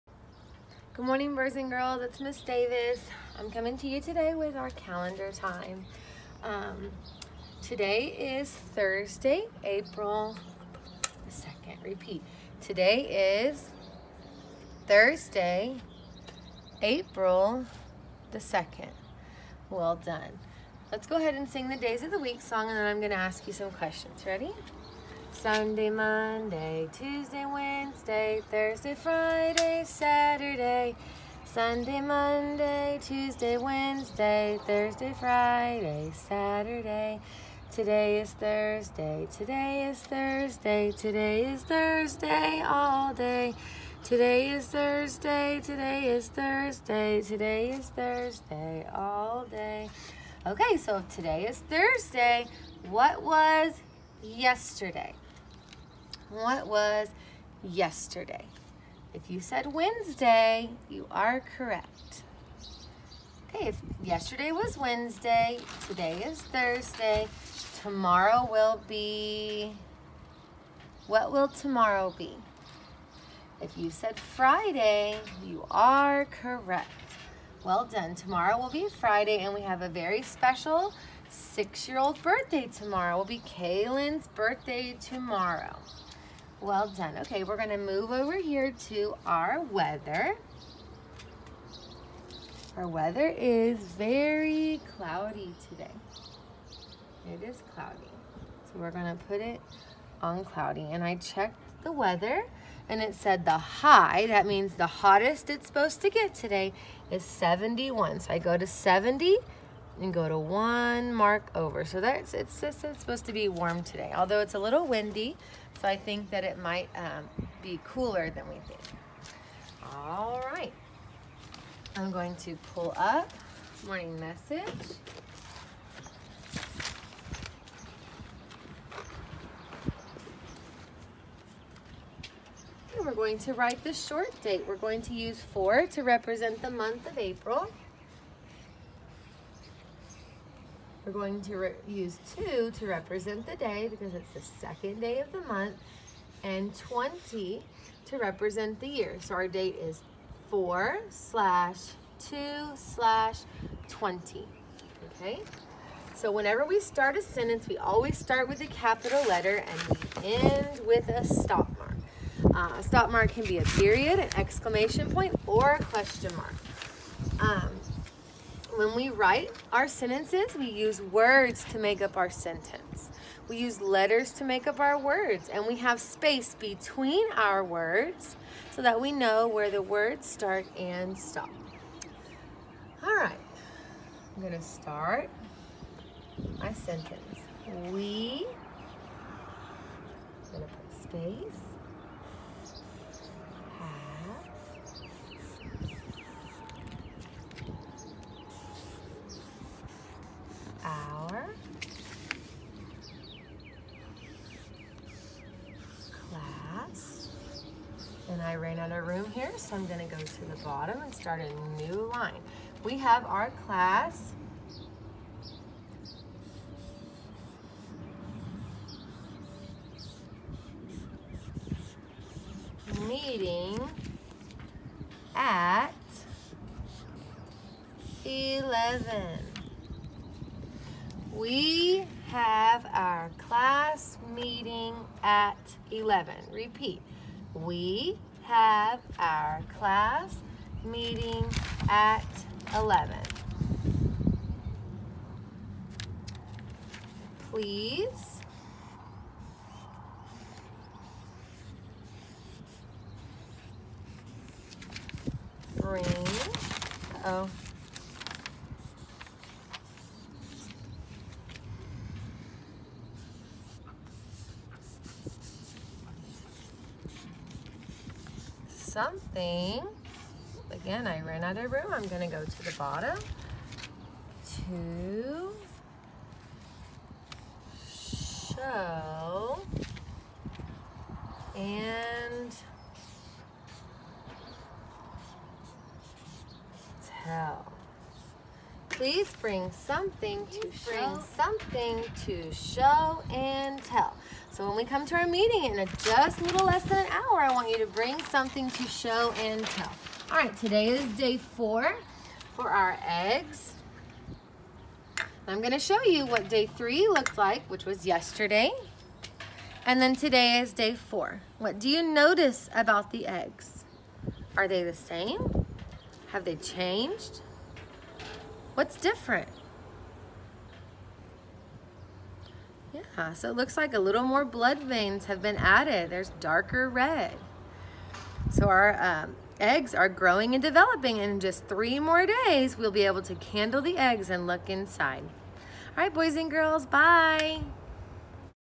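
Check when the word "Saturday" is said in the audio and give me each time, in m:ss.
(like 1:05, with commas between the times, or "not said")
0:29, 0:36.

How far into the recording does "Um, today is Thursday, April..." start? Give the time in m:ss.
0:06.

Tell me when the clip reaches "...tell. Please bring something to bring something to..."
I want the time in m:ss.
4:47.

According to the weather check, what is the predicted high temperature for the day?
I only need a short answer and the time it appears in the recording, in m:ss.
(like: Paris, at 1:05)
71, at 1:47.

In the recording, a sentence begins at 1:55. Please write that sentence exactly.
So I think that it might um, be cooler than we think.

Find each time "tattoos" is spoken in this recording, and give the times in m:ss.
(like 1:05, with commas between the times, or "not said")
not said.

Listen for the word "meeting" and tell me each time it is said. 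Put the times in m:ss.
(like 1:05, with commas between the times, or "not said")
3:43, 3:54, 4:00, 4:55.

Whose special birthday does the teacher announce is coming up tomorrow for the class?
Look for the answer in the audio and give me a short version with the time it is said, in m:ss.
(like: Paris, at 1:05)
Kaylin, at 1:23.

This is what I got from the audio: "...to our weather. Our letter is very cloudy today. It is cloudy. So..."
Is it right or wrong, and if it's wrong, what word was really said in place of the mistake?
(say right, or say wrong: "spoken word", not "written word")
wrong: "weather", not "letter".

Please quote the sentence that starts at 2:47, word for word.
Um, when we write our sentences, we use words to make up our sentence.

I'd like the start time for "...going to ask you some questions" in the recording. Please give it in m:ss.
0:22.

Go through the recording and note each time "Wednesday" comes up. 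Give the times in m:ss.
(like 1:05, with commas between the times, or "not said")
0:27, 0:33, 0:59, 1:04.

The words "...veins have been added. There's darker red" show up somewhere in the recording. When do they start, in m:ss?
5:24.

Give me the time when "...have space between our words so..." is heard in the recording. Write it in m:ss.
2:55.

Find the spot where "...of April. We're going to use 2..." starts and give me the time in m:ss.
2:17.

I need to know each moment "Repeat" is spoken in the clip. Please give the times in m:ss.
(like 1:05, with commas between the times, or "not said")
0:11, 3:56.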